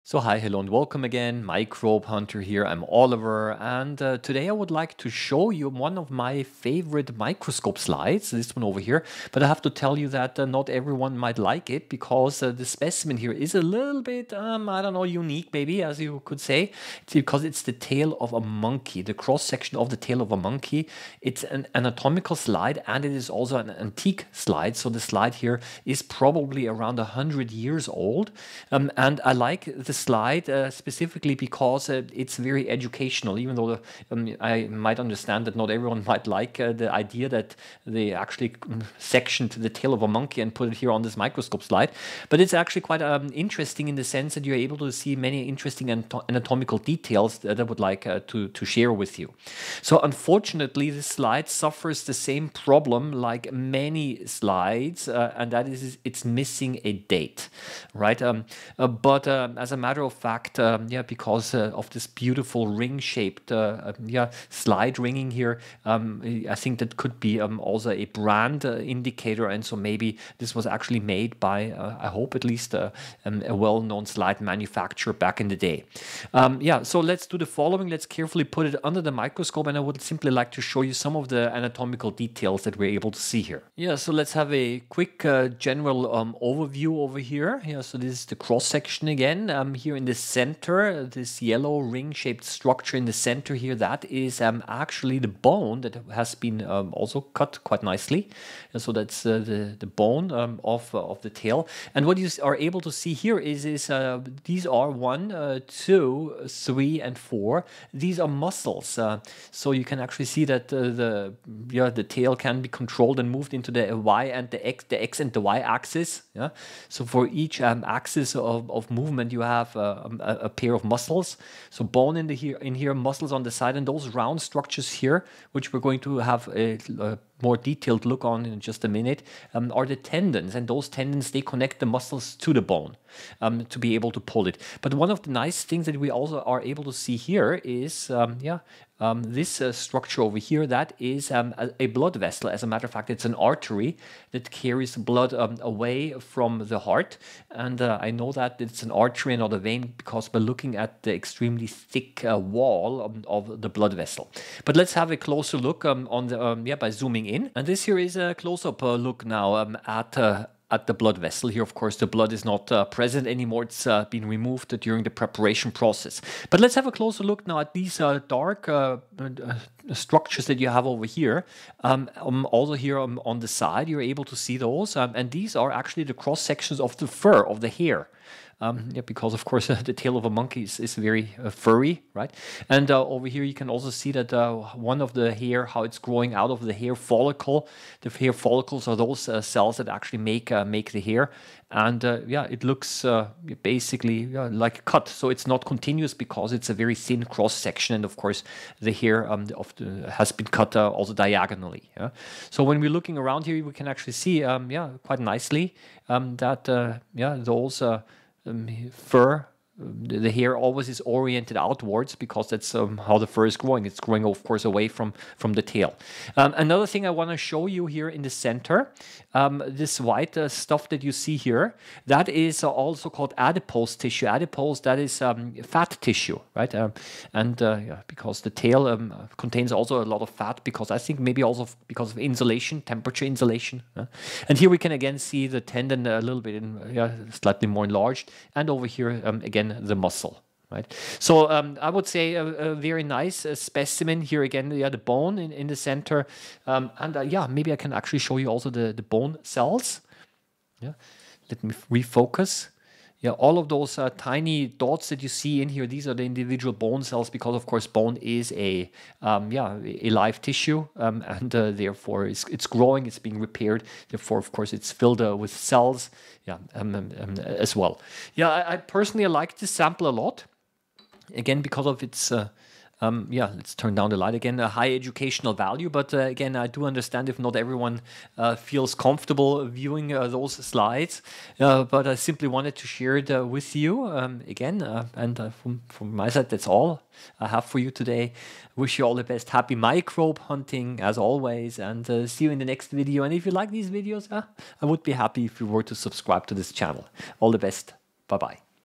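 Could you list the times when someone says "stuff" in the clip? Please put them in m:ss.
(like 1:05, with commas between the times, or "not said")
3:40.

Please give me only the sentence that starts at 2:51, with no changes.
Um, um, also here on, on, the side, you're able to see those.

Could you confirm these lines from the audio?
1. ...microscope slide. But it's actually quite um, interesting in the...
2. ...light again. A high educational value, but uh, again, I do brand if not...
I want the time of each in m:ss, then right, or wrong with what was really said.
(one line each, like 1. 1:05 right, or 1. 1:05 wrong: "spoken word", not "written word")
1. 0:41 right
2. 4:34 wrong: "understand", not "brand".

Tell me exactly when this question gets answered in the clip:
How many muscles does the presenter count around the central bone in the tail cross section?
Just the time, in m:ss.
1:47.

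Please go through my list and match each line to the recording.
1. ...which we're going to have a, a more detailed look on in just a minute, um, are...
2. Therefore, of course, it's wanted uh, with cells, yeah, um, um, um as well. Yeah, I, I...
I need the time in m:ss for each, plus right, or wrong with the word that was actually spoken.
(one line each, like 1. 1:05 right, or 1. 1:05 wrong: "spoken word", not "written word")
1. 2:05 right
2. 4:24 wrong: "filled", not "wanted".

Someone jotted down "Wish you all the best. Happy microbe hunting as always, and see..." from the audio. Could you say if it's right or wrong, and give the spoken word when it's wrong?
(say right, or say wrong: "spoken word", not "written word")
right.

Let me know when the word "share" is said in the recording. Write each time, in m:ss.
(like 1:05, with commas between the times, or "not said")
0:48, 4:42.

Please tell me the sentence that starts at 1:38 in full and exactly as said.
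And so that's uh, the, the bone um, of, uh, of the tail.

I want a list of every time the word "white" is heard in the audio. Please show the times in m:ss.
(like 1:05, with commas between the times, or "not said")
3:39.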